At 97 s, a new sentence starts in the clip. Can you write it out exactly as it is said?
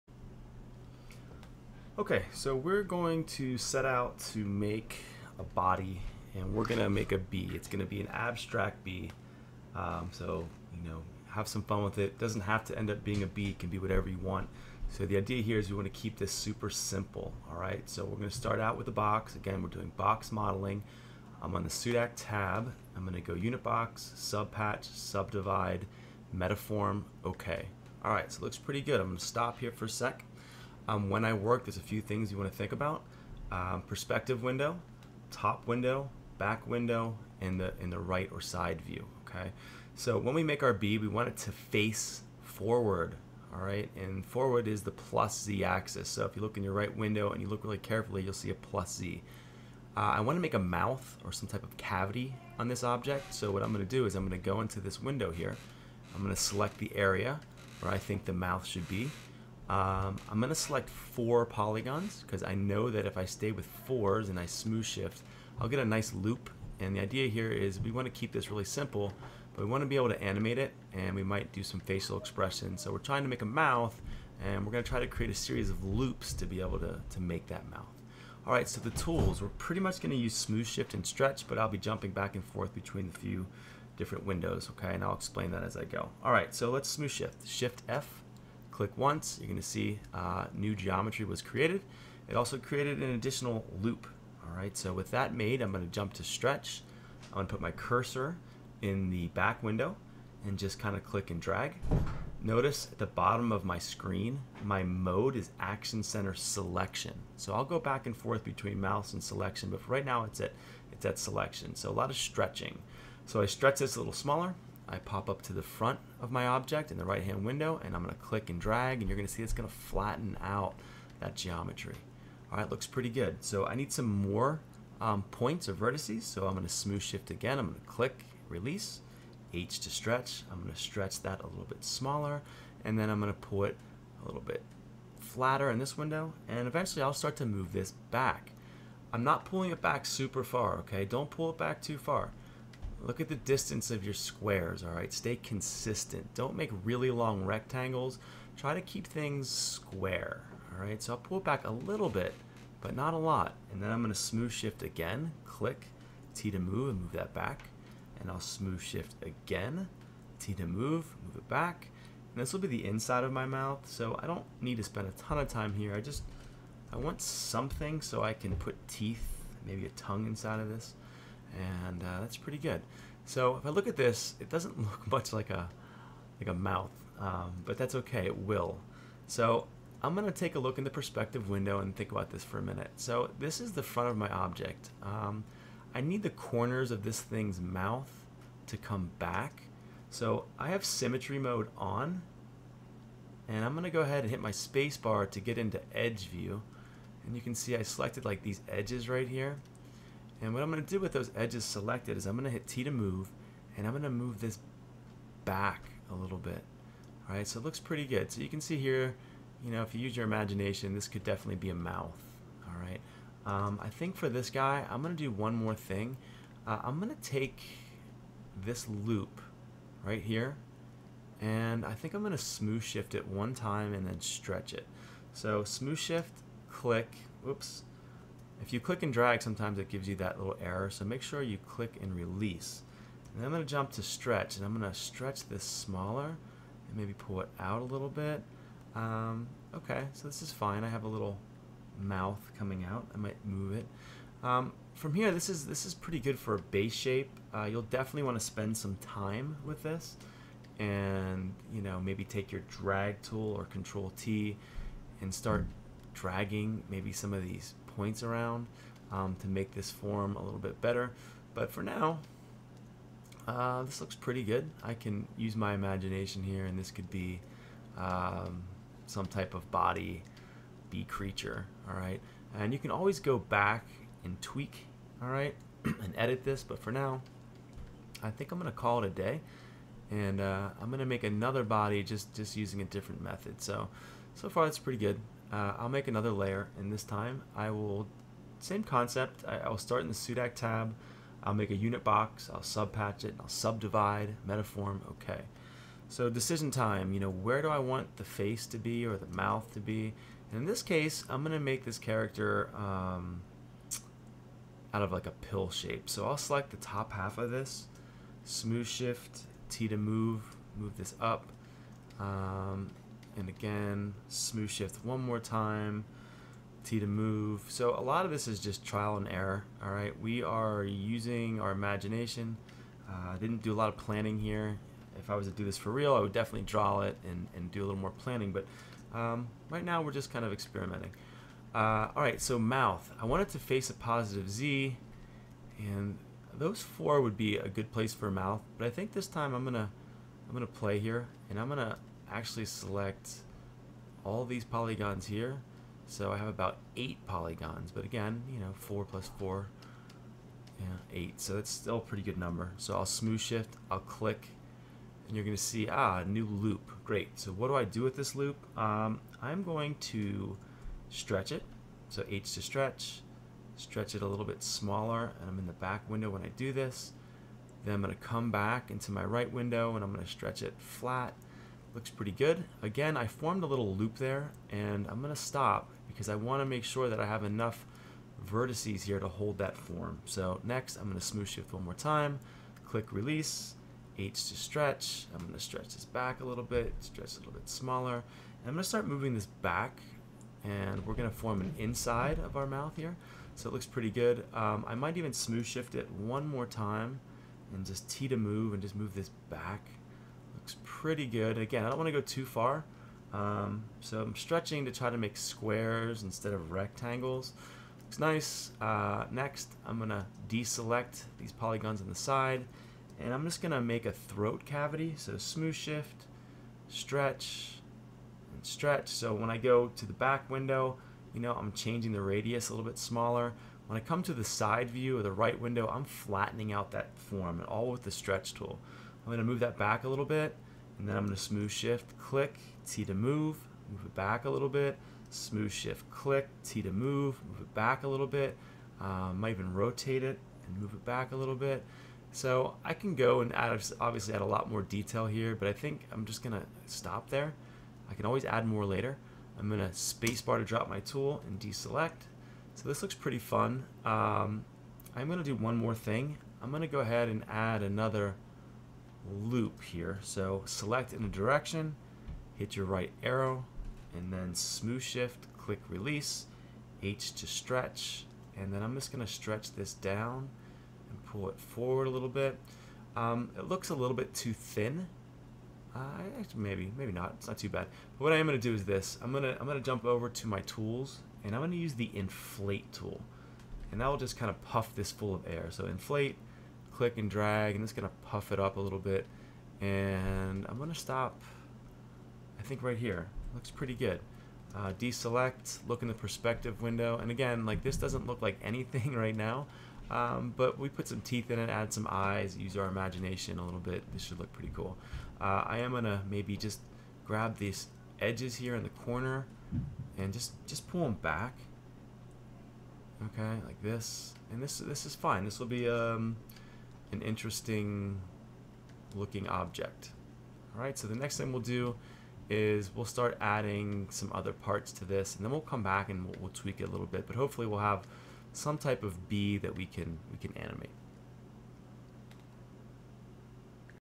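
I'm gonna put my cursor in the back window and just kind of click and drag.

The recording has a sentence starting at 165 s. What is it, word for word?
I just, I want something so I can put teeth, maybe a tongue inside of this and uh, that's pretty good.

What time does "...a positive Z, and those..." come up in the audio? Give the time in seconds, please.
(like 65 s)
333 s.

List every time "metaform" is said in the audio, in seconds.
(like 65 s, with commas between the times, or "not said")
26 s, 294 s.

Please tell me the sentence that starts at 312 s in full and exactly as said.
Um, and again, smooth shift one more time, T to move.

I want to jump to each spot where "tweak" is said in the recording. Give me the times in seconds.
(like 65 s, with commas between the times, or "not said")
274 s, 526 s.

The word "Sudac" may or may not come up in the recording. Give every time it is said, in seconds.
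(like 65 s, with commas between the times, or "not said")
21 s, 290 s.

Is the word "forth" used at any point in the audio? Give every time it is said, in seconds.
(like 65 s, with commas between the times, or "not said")
82 s, 108 s.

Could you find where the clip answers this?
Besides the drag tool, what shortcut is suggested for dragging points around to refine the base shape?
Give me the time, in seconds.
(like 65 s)
253 s.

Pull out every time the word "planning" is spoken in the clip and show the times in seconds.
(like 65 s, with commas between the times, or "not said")
323 s, 328 s.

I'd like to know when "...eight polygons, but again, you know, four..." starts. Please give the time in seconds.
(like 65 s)
346 s.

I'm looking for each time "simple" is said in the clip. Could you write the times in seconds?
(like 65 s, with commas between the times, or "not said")
16 s, 68 s.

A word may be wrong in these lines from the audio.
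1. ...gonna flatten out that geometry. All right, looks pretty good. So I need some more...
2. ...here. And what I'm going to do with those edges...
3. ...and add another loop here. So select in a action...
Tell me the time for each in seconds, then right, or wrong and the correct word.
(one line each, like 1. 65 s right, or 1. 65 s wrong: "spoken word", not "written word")
1. 119 s right
2. 199 s right
3. 457 s wrong: "direction", not "action".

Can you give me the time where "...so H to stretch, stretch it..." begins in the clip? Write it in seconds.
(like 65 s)
362 s.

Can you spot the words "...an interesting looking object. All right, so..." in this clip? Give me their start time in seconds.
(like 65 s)
517 s.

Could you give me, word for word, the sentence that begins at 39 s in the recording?
So when we make our bee, we want it to face forward, all right?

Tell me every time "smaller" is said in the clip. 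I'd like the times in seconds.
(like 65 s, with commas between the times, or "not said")
114 s, 131 s, 235 s, 364 s, 387 s, 422 s.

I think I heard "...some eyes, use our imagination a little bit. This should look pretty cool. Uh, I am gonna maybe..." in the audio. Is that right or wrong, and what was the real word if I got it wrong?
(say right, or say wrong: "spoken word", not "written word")
right.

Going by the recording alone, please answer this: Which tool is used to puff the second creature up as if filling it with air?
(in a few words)
inflate tool.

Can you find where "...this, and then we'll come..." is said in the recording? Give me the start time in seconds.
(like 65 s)
525 s.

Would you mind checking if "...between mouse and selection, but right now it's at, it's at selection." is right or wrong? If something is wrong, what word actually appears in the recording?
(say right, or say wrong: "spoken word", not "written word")
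right.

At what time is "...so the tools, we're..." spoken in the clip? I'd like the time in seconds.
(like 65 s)
78 s.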